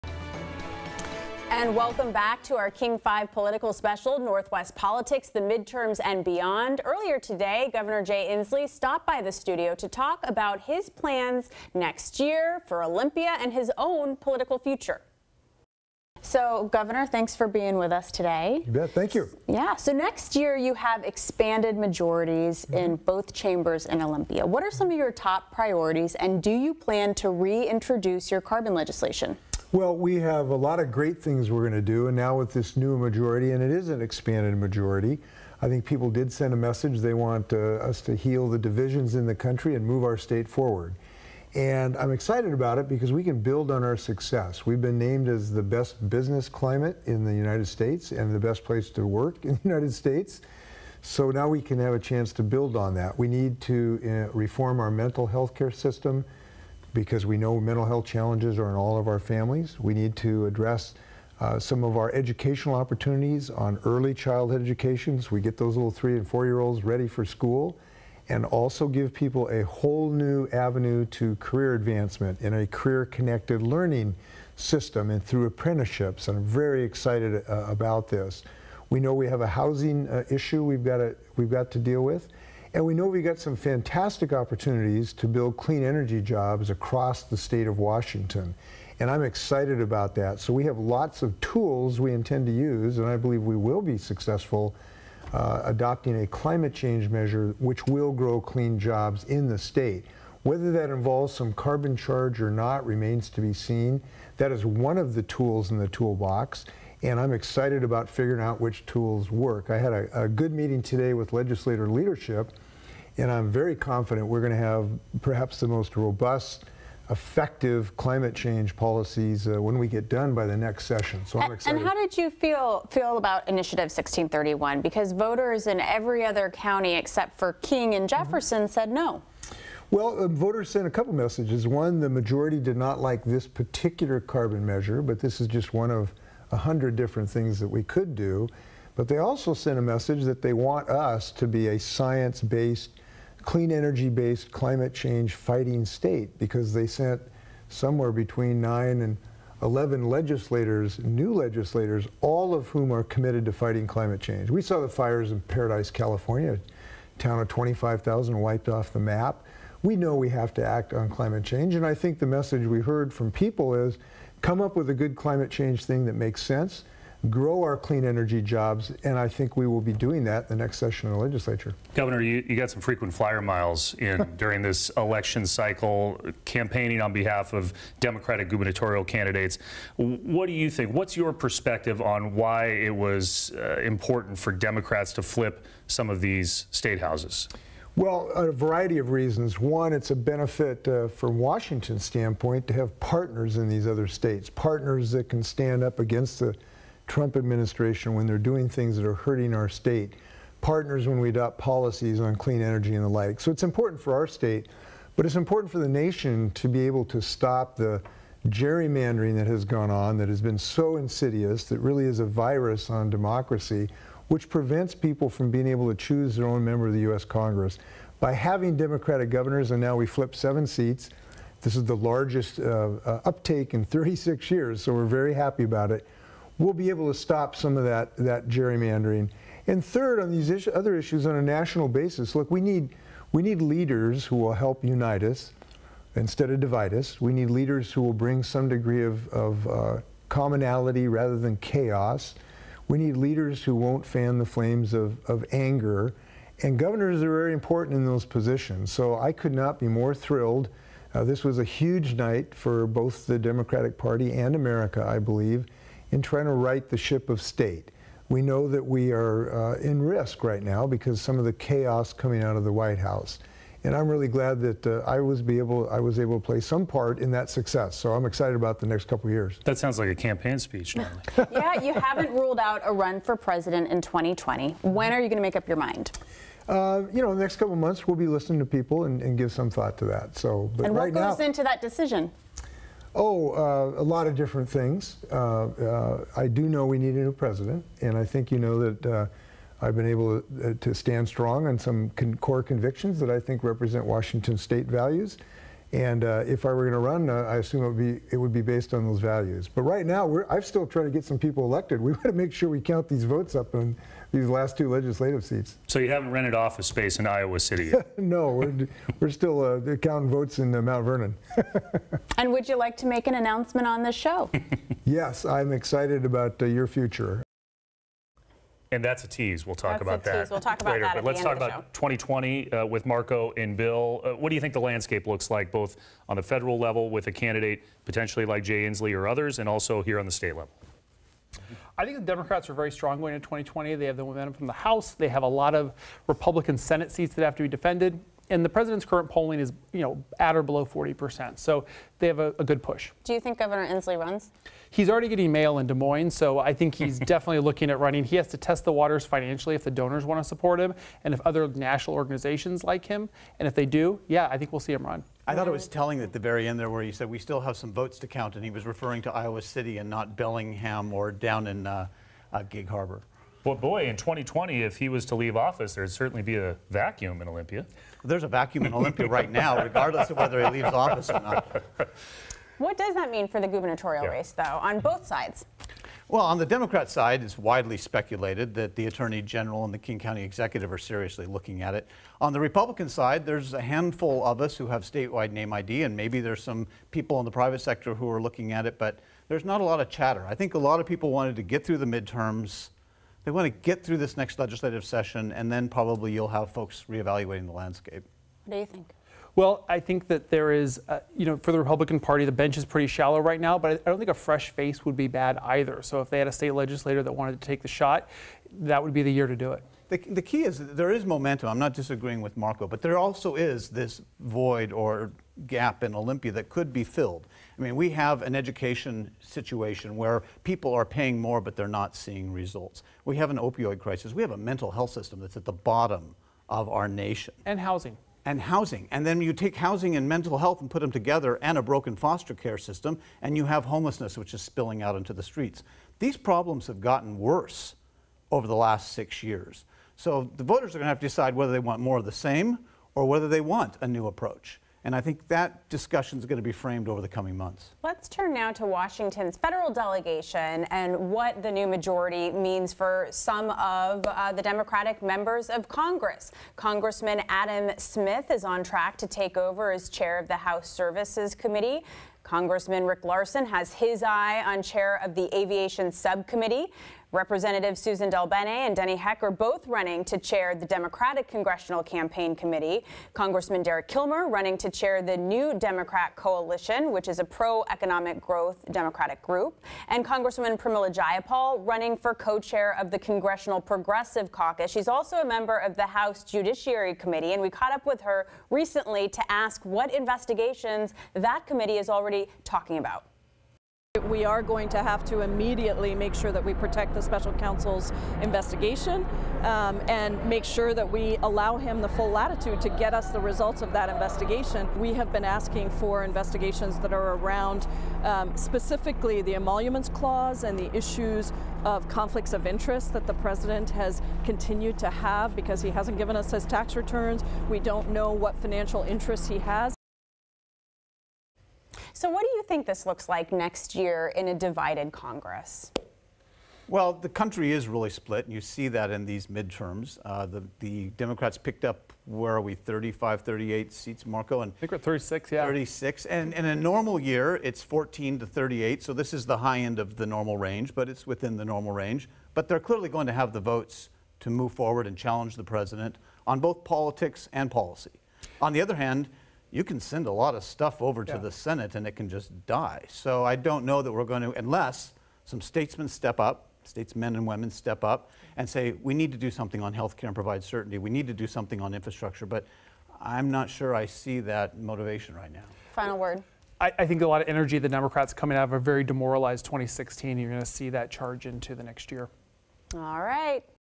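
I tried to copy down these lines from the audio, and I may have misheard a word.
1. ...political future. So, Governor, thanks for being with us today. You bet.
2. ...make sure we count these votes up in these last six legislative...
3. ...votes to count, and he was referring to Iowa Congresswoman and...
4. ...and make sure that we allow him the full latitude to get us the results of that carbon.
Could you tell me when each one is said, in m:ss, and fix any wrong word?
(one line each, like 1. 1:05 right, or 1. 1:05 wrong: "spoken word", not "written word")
1. 0:14 right
2. 5:02 wrong: "two", not "six"
3. 5:57 wrong: "City", not "Congresswoman"
4. 8:20 wrong: "investigation", not "carbon".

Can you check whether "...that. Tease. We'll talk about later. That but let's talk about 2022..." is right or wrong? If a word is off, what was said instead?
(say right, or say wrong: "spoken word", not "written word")
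wrong: "2020", not "2022".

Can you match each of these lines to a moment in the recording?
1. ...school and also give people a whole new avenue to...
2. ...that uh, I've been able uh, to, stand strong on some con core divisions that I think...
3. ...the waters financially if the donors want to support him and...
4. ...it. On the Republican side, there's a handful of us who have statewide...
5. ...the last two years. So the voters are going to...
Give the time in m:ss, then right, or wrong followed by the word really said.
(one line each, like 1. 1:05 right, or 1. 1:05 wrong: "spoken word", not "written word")
1. 1:07 right
2. 4:48 wrong: "convictions", not "divisions"
3. 5:48 right
4. 6:21 right
5. 7:18 wrong: "six", not "two".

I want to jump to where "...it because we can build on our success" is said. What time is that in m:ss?
0:42.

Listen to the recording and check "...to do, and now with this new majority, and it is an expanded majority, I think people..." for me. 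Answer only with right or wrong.
right.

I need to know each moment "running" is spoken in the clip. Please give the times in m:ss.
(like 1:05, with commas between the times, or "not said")
5:47, 7:49, 7:54, 8:01.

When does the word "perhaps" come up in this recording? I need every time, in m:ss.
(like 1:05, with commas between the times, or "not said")
1:55.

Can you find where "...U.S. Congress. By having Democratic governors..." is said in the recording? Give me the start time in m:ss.
3:37.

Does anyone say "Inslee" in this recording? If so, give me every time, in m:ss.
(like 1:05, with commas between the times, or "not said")
0:08, 5:28, 5:43.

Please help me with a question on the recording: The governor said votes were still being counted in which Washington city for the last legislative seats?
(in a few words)
Mount Vernon.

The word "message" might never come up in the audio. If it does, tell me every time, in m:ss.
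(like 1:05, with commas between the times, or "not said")
0:36, 2:11, 2:19, 2:42.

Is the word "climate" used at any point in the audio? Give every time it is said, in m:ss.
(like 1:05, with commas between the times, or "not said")
0:46, 1:36, 1:57, 2:24, 2:33, 2:41, 2:45.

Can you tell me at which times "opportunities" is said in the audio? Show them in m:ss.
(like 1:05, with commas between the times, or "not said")
1:02, 1:24.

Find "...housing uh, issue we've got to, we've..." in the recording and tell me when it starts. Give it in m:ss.
1:19.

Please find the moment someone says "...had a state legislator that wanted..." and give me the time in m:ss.
6:46.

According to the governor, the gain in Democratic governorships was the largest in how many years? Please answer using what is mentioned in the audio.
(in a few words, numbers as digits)
36 years.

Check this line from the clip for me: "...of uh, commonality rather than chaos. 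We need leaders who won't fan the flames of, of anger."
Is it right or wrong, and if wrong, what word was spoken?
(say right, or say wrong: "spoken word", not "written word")
right.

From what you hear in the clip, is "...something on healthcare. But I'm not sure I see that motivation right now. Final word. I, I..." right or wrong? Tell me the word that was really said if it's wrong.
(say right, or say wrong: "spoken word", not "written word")
wrong: "infrastructure", not "healthcare".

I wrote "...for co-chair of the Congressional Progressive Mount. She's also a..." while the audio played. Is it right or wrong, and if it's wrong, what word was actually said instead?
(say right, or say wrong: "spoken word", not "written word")
wrong: "Caucus", not "Mount".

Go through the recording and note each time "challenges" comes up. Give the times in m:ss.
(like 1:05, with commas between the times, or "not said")
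0:58, 9:05.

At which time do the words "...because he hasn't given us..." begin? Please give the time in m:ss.
8:35.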